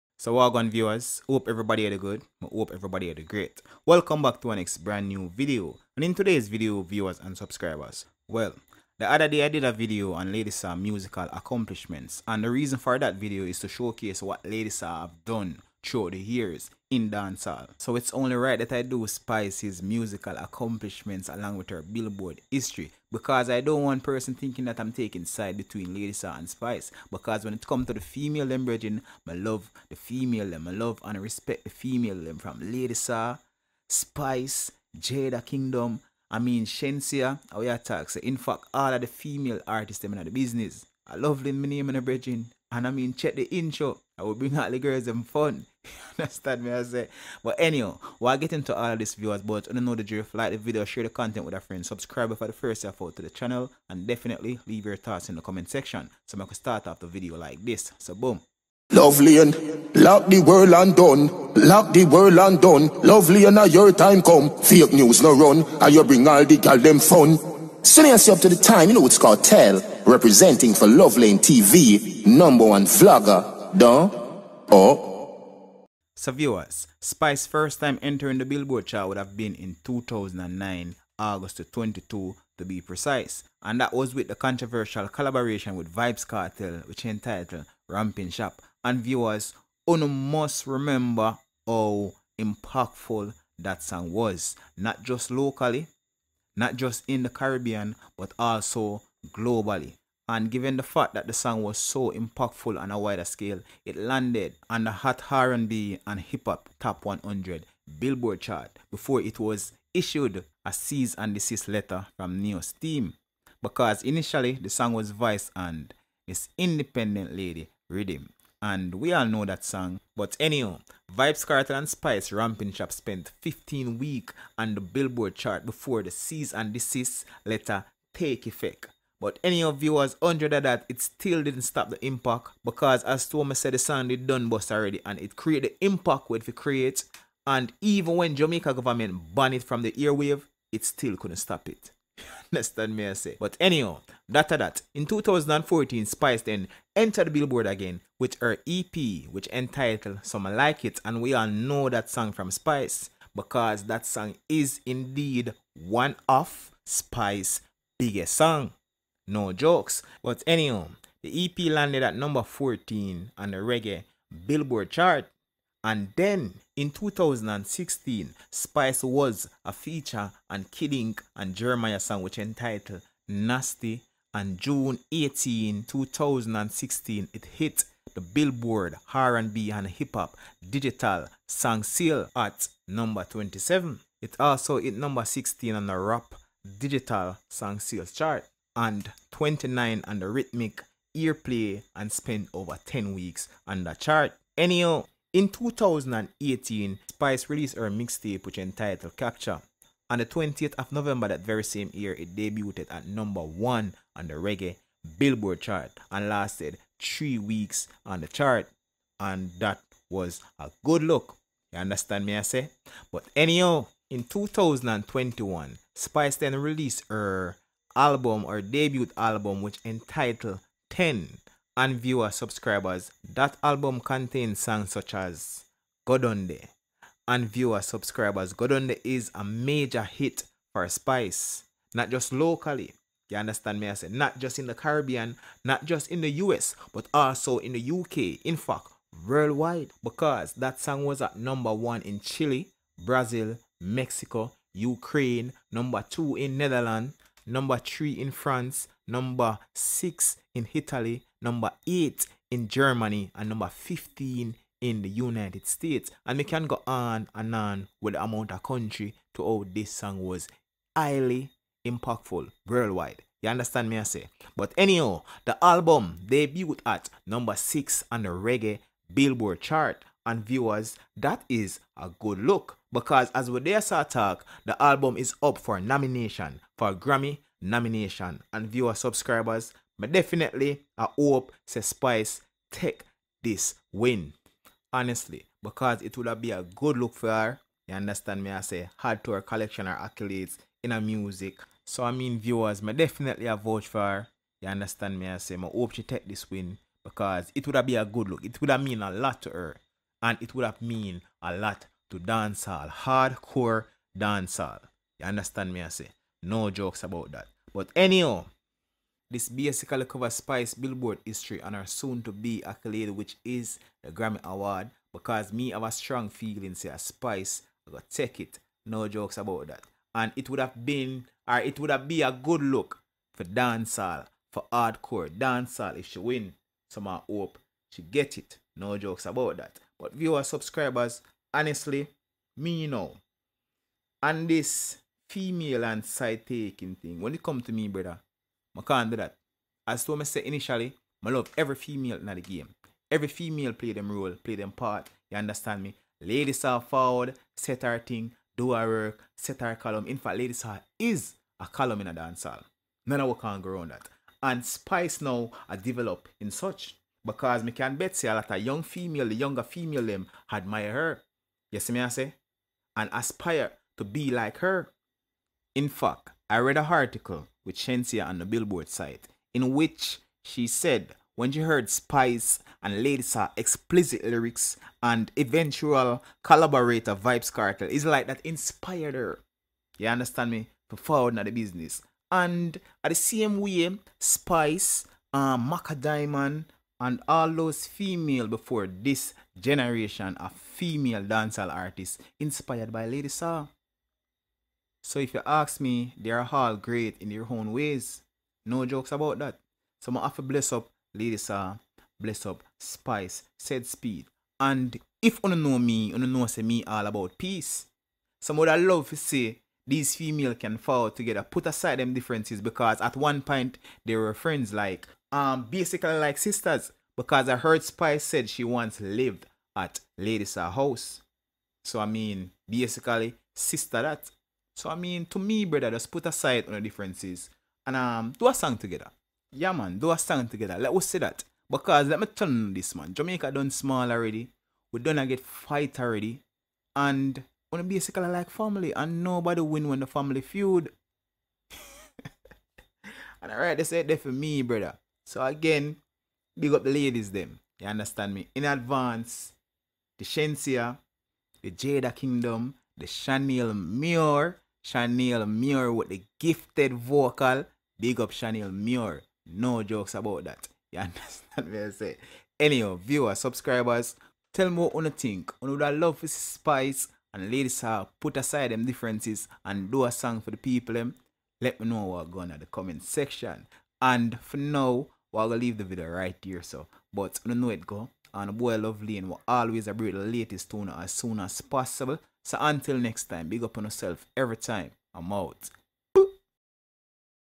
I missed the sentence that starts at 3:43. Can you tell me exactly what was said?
That album contains songs such as Go Down Deh and viewer subscribers.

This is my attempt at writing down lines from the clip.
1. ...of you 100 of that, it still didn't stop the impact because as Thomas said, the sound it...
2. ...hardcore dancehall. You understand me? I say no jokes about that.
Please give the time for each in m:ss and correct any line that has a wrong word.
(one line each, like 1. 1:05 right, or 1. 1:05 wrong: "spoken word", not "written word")
1. 2:09 right
2. 5:02 right.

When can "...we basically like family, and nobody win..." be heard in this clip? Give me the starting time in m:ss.
7:17.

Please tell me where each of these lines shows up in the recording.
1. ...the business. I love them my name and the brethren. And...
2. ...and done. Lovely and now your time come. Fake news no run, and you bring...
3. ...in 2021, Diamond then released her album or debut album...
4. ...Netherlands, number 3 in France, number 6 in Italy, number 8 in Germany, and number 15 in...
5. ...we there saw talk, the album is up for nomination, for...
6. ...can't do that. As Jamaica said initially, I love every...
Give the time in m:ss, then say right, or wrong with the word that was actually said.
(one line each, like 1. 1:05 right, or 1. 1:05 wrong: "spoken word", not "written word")
1. 0:40 right
2. 1:02 right
3. 3:34 wrong: "Spice", not "Diamond"
4. 4:06 right
5. 4:33 right
6. 5:38 wrong: "Thomas", not "Jamaica".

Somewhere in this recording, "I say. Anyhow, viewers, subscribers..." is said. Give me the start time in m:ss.
7:41.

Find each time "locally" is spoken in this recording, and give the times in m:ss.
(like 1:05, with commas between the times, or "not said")
1:35, 3:52.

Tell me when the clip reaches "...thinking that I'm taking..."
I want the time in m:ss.
0:24.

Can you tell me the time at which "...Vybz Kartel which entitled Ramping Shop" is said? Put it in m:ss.
1:25.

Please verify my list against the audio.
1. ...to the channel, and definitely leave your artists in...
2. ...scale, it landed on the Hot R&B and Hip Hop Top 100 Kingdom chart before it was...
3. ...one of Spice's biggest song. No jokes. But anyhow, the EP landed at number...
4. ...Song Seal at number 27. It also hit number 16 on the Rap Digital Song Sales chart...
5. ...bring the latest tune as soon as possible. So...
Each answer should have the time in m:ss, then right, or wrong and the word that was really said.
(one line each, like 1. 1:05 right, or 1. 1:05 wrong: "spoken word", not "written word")
1. 0:53 wrong: "thoughts", not "artists"
2. 1:43 wrong: "Billboard", not "Kingdom"
3. 2:35 right
4. 3:01 right
5. 7:59 right.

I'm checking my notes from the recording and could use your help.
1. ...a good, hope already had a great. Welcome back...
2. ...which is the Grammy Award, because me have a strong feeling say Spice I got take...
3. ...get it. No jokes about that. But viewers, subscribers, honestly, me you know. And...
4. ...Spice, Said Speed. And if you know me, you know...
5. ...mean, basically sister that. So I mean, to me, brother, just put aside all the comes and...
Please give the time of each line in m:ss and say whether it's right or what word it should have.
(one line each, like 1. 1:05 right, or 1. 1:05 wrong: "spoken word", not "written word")
1. 0:01 wrong: "everybody", not "already"
2. 5:13 right
3. 5:28 right
4. 6:42 right
5. 7:02 wrong: "differences", not "comes".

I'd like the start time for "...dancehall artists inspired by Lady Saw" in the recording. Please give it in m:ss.
6:31.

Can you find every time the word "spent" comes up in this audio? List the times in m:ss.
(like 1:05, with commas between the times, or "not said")
2:02, 3:12.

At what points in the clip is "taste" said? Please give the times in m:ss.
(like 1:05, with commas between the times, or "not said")
not said.